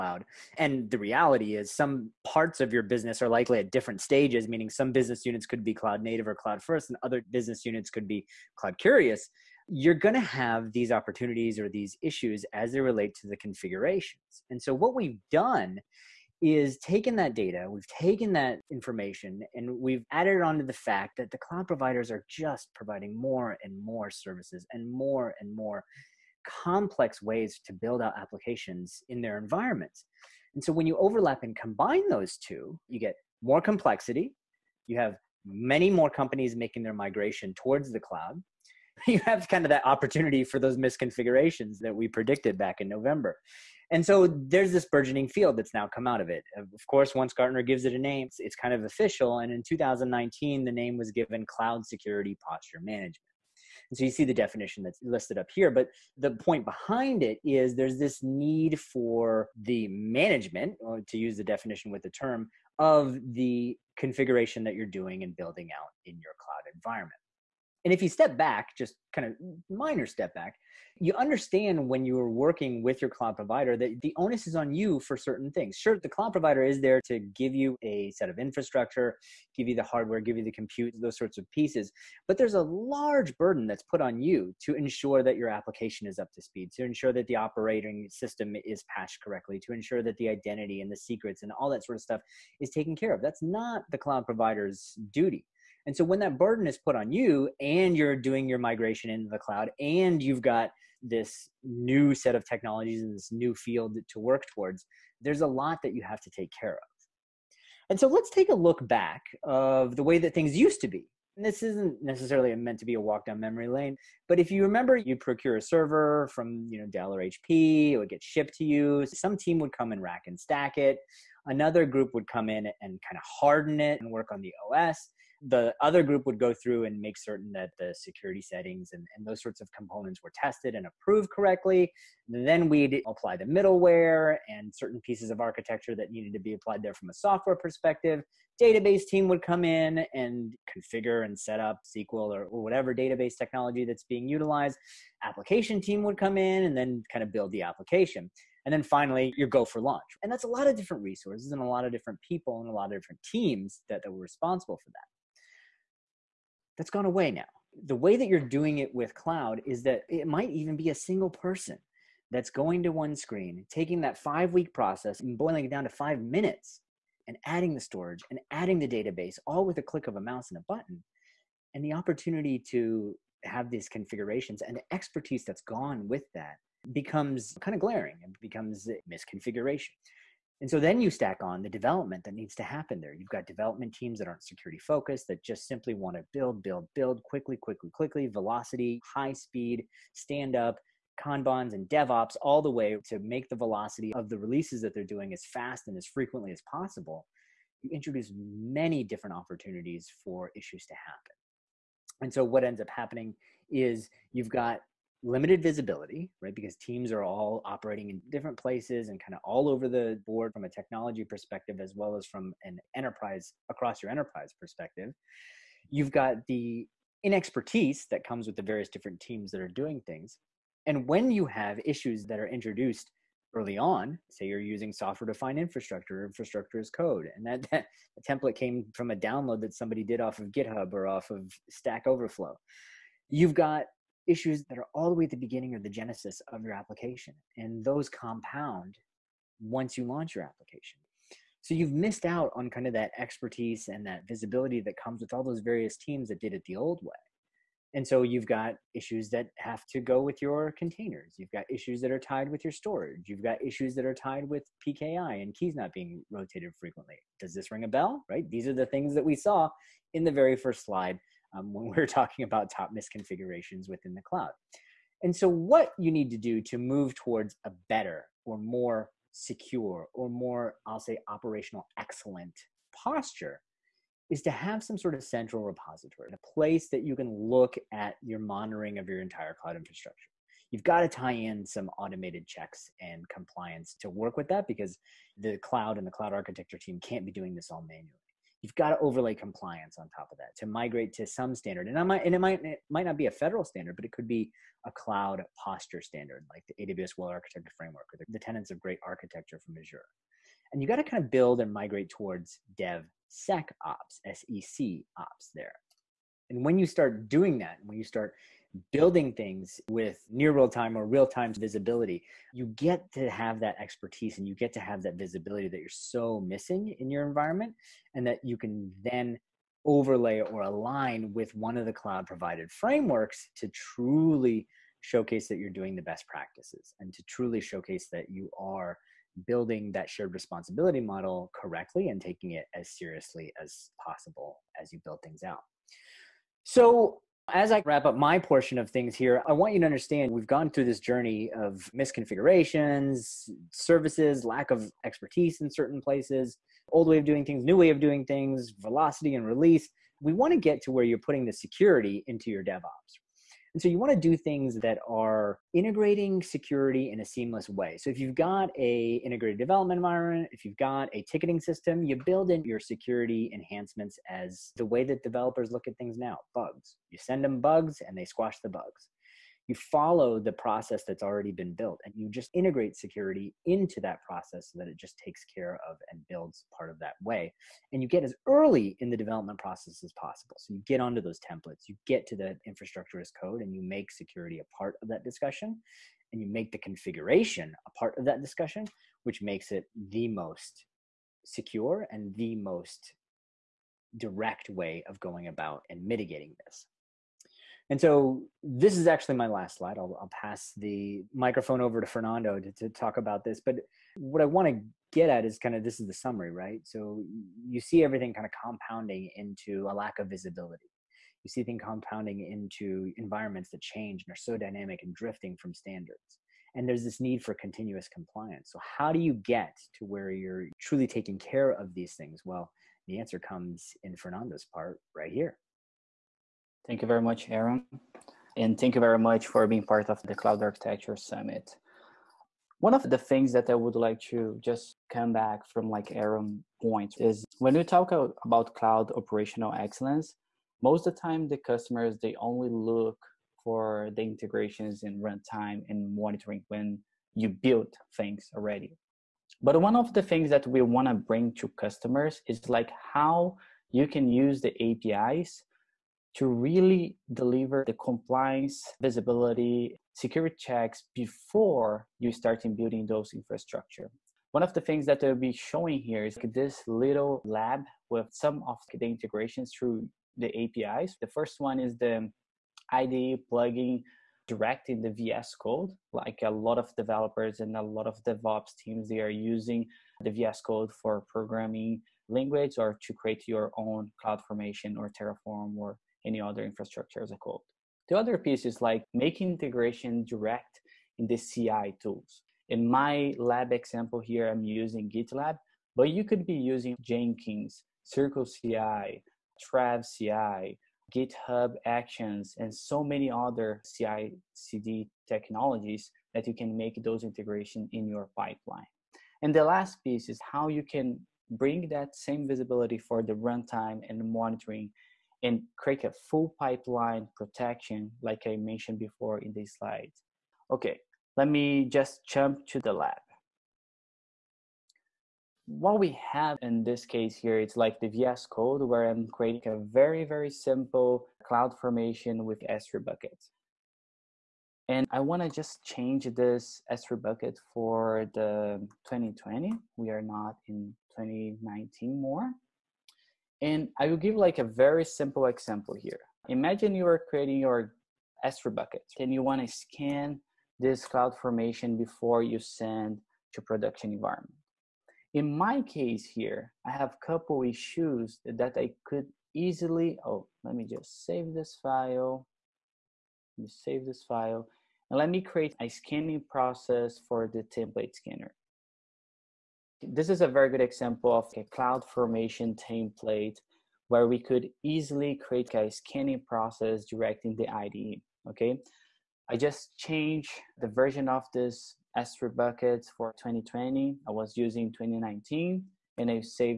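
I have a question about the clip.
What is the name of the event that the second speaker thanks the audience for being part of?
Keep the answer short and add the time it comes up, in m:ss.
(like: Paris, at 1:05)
Cloud Architecture Summit, at 7:10.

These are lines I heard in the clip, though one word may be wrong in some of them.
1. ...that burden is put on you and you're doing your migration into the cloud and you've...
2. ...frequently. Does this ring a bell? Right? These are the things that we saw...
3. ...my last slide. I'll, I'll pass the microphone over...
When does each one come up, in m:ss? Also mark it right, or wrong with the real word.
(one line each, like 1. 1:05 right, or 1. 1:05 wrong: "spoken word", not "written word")
1. 1:36 right
2. 4:16 right
3. 6:39 right.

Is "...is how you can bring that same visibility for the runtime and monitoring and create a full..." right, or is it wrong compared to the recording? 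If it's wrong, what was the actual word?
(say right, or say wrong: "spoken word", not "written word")
right.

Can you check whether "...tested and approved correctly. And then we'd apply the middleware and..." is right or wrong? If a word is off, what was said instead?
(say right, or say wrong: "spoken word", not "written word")
right.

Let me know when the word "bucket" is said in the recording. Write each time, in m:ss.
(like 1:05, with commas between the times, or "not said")
8:53, 8:57, 9:08, 9:42.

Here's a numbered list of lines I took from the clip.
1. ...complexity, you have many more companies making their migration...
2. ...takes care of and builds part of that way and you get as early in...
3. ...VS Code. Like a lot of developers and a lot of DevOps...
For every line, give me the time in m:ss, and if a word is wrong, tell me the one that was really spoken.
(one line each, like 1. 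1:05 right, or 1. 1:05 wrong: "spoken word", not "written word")
1. 0:33 right
2. 6:15 right
3. 7:55 right.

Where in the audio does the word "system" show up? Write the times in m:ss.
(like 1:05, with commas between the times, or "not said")
1:28, 6:01.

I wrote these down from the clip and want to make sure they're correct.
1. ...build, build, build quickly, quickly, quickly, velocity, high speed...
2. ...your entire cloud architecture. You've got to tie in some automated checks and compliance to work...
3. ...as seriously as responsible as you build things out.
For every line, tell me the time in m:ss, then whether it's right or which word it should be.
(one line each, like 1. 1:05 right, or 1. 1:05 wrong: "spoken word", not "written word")
1. 3:06 right
2. 4:39 wrong: "infrastructure", not "architecture"
3. 5:32 wrong: "possible", not "responsible".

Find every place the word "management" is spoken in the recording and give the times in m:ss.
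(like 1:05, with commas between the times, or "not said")
0:52, 0:59.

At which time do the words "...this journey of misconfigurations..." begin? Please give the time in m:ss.
5:40.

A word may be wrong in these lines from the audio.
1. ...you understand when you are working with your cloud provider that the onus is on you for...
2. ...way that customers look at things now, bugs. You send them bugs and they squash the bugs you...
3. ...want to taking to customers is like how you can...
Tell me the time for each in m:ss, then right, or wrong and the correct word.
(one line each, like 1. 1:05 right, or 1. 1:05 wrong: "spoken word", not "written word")
1. 1:11 right
2. 6:04 wrong: "developers", not "customers"
3. 7:30 wrong: "bring", not "taking".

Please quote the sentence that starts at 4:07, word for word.
And so you've got issues that have to go with your containers.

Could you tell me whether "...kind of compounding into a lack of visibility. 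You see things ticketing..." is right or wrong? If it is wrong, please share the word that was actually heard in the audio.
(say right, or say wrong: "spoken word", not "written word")
wrong: "compounding", not "ticketing".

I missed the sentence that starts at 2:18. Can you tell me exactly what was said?
Database team would come in and configure and set up SQL or, or whatever database technology that's being utilized.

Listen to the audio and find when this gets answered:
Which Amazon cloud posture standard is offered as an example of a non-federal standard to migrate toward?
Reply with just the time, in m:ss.
4:56.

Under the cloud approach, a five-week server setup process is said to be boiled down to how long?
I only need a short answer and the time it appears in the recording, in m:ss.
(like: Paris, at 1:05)
5 minutes, at 2:45.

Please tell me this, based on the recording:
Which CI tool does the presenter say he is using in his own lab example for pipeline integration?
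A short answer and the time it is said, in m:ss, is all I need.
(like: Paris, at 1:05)
GitLab, at 8:15.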